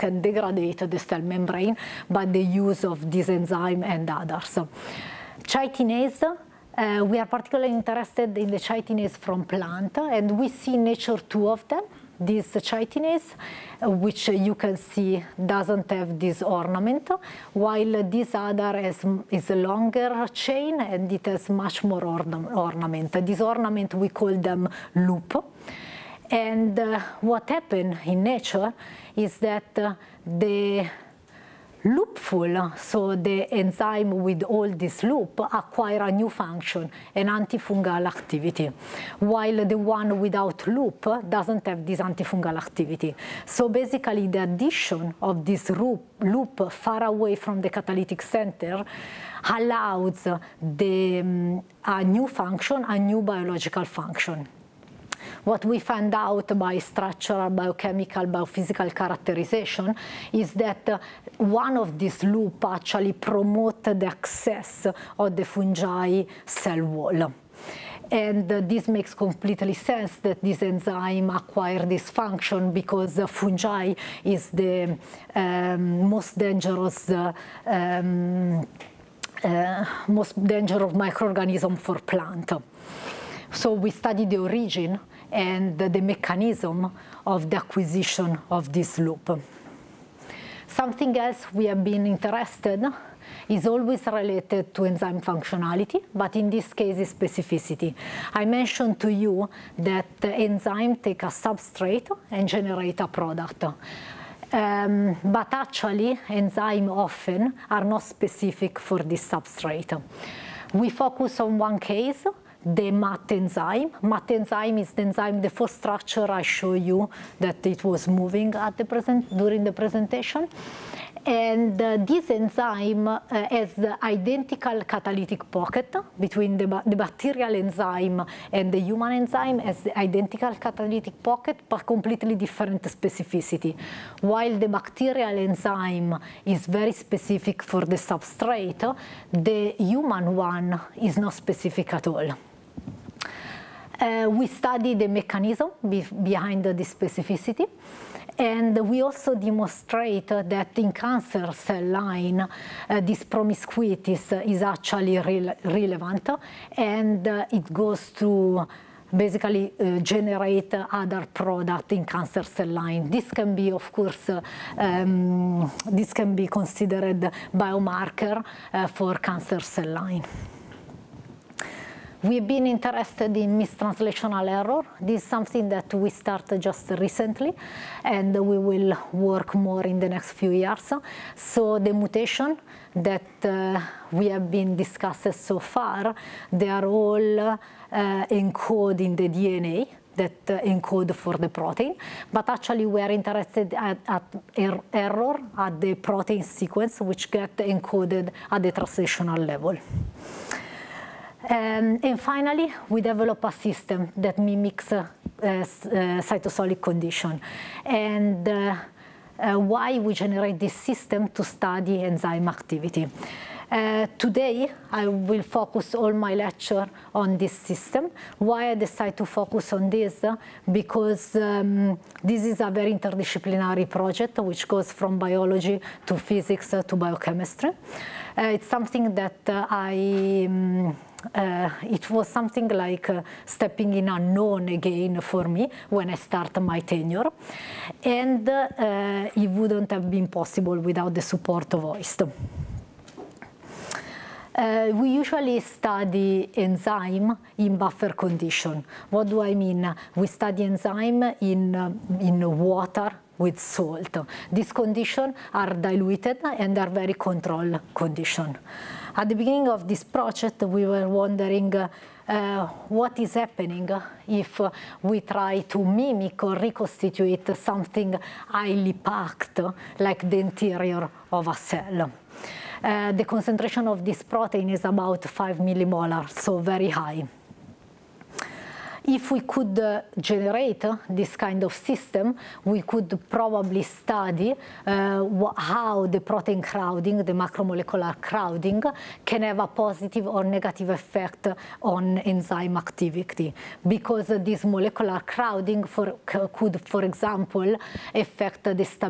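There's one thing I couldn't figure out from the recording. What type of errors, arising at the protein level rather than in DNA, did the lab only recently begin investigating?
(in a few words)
Mistranslational error.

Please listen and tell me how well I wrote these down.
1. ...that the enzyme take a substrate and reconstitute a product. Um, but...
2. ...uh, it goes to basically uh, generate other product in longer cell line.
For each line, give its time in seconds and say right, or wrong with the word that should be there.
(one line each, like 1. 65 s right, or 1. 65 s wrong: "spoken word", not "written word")
1. 99 s wrong: "generate", not "reconstitute"
2. 157 s wrong: "cancer", not "longer".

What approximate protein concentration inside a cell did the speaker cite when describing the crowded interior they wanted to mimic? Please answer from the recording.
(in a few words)
5 millimolar.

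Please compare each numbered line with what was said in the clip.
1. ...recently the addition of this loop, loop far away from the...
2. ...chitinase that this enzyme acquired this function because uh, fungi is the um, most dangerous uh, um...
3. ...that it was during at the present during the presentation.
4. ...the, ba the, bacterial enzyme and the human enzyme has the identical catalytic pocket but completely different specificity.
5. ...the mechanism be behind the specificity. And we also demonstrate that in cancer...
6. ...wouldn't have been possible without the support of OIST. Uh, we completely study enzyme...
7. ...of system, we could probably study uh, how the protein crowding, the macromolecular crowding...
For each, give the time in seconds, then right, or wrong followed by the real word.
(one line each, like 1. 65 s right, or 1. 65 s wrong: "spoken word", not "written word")
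1. 43 s wrong: "basically", not "recently"
2. 69 s wrong: "sense", not "chitinase"
3. 117 s wrong: "moving", not "during"
4. 126 s right
5. 144 s right
6. 239 s wrong: "usually", not "completely"
7. 281 s right.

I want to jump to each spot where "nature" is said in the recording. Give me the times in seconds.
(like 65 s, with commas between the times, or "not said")
10 s, 28 s.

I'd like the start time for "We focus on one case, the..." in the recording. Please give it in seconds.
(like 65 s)
110 s.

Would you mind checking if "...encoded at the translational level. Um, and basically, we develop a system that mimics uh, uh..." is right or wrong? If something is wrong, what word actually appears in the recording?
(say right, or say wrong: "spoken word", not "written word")
wrong: "finally", not "basically".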